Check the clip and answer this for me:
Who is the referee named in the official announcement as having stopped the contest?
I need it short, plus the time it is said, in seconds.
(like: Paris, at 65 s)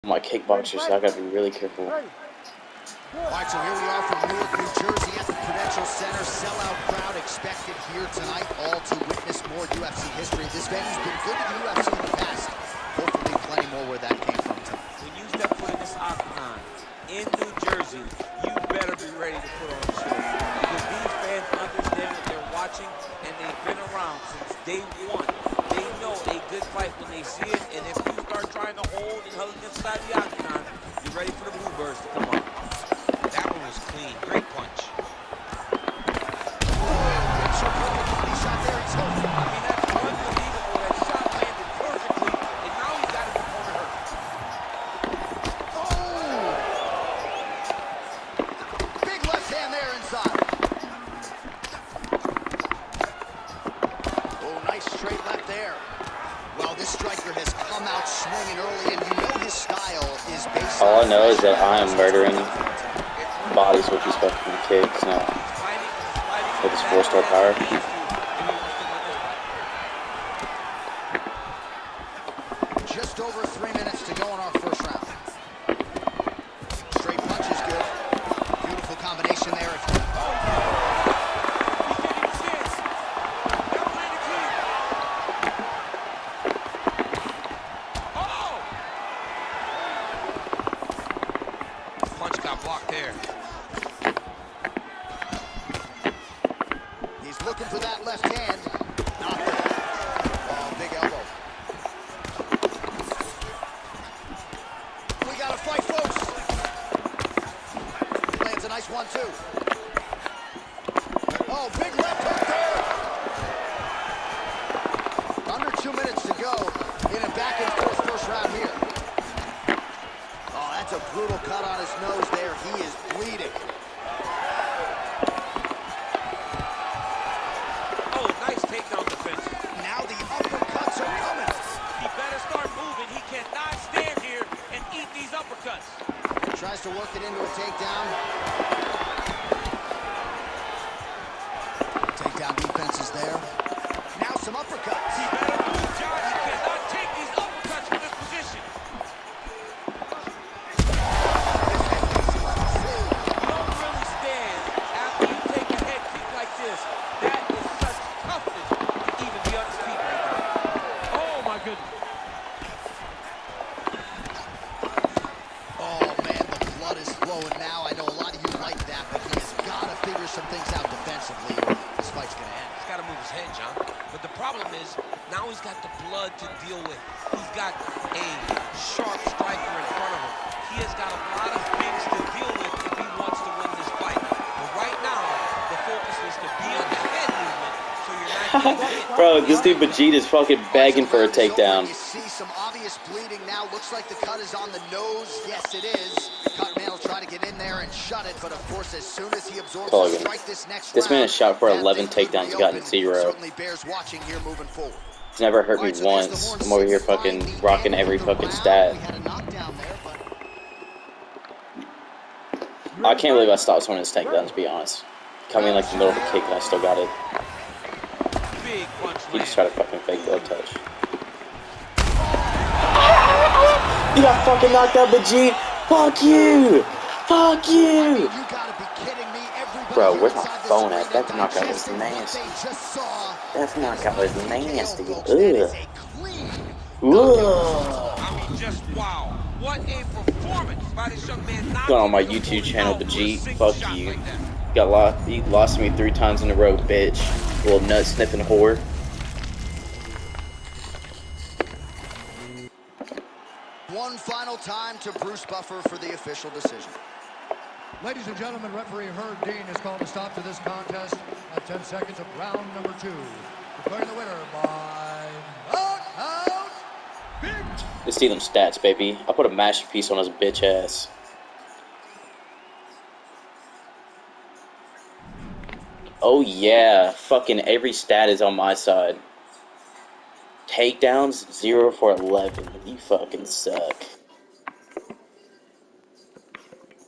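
Herb Dean, at 259 s.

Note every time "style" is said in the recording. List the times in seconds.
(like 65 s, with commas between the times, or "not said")
59 s.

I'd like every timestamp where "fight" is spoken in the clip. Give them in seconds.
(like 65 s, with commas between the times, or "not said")
26 s, 105 s, 172 s.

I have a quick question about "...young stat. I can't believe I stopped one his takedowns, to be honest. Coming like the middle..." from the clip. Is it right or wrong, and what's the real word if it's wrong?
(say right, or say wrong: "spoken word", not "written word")
wrong: "fucking", not "young".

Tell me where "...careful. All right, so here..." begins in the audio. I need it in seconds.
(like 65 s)
1 s.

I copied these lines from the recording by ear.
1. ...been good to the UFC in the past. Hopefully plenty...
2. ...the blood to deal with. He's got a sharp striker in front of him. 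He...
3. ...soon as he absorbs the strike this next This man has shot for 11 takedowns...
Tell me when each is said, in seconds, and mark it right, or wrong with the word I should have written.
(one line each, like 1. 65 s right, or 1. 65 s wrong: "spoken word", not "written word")
1. 11 s right
2. 175 s right
3. 199 s right.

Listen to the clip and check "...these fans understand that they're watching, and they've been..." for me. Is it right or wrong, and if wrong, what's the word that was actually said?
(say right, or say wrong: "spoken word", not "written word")
right.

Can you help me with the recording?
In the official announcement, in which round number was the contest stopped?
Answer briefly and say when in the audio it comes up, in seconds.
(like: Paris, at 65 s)
2, at 263 s.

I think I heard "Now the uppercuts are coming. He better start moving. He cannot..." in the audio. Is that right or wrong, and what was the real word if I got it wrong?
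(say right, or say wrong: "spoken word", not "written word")
right.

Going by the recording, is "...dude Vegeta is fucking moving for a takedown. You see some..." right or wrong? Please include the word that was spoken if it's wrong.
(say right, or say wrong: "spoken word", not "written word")
wrong: "begging", not "moving".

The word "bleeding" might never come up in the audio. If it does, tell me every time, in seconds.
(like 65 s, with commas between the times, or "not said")
123 s, 193 s.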